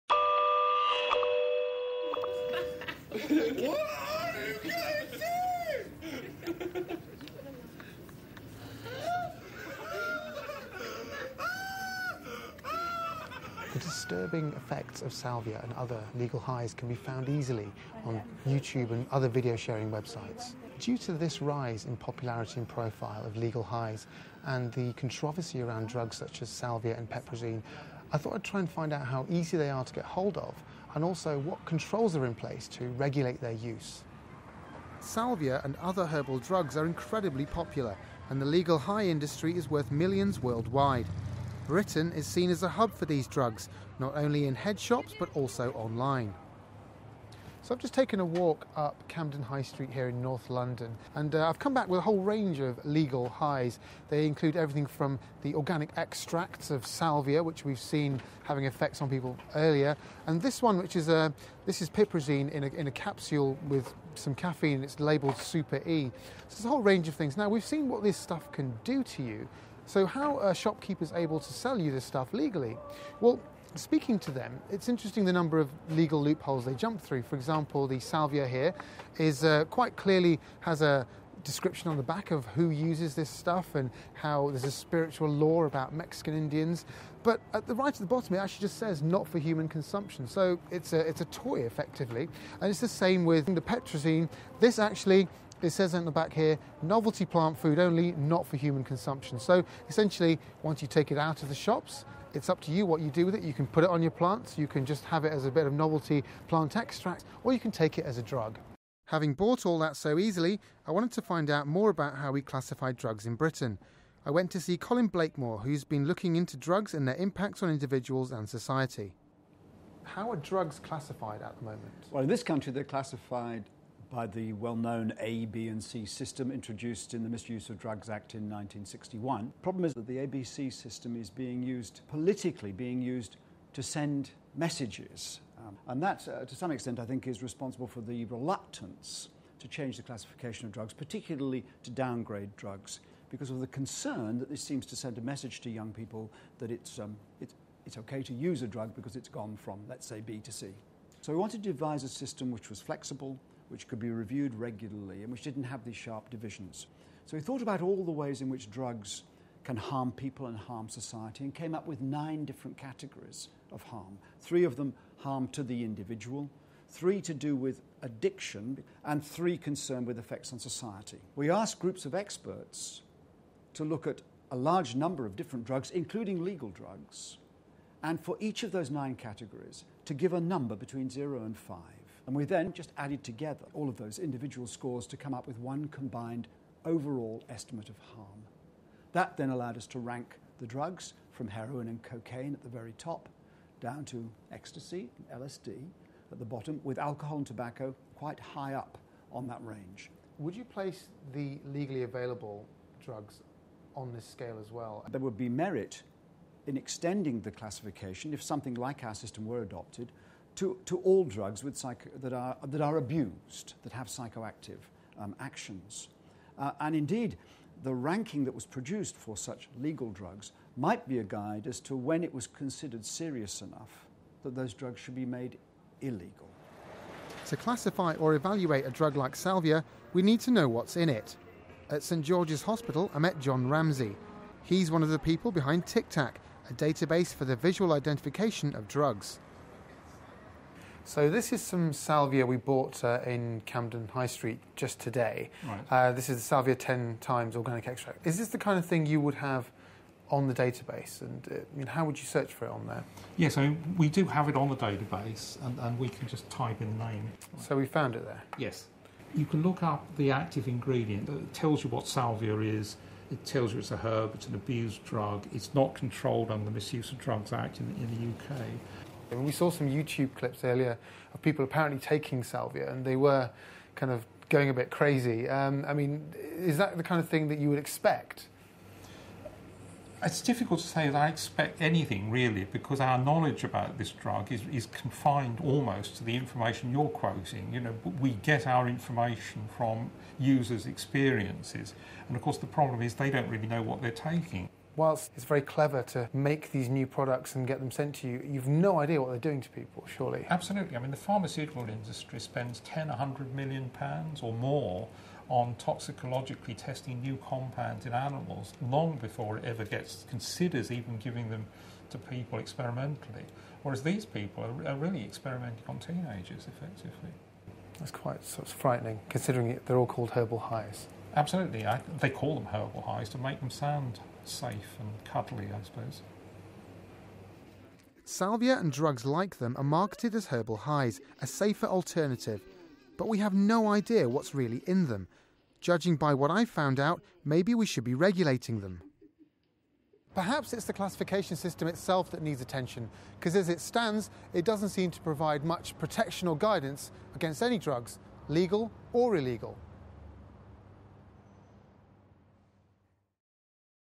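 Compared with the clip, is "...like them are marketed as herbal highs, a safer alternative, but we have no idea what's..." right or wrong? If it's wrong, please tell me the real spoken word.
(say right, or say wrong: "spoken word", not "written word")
right.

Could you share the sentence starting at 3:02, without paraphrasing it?
And we then just added together all of those individual scores to come up with one combined overall estimate of harm.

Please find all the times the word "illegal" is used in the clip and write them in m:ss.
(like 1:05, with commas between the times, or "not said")
3:46, 5:49.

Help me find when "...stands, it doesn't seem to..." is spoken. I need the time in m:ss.
5:43.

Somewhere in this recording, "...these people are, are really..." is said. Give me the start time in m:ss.
5:14.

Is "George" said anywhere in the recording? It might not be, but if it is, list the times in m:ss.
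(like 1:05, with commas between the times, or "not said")
3:52.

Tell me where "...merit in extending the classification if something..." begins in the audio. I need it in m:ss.
3:25.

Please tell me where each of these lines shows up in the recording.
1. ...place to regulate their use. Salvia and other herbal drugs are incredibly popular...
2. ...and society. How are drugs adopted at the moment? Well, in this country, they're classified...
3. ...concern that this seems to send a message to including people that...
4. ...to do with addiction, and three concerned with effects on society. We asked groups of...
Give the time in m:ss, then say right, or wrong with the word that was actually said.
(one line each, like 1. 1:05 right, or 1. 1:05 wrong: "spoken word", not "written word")
1. 0:32 right
2. 1:58 wrong: "classified", not "adopted"
3. 2:23 wrong: "young", not "including"
4. 2:47 right.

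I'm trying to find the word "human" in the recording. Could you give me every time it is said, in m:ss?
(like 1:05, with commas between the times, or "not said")
1:29, 1:38.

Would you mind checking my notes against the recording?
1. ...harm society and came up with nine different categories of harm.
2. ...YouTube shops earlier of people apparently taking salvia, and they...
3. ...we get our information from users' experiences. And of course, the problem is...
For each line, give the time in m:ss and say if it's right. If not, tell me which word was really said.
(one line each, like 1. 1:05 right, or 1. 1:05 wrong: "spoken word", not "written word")
1. 2:40 right
2. 4:29 wrong: "clips", not "shops"
3. 4:48 right.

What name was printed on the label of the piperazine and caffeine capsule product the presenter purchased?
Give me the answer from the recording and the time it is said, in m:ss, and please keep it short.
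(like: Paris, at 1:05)
Super E, at 1:05.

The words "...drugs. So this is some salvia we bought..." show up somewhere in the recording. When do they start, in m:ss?
3:58.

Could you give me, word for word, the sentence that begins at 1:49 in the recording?
Having bought all that so easily, I wanted to find out more about how we classify drugs in Britain.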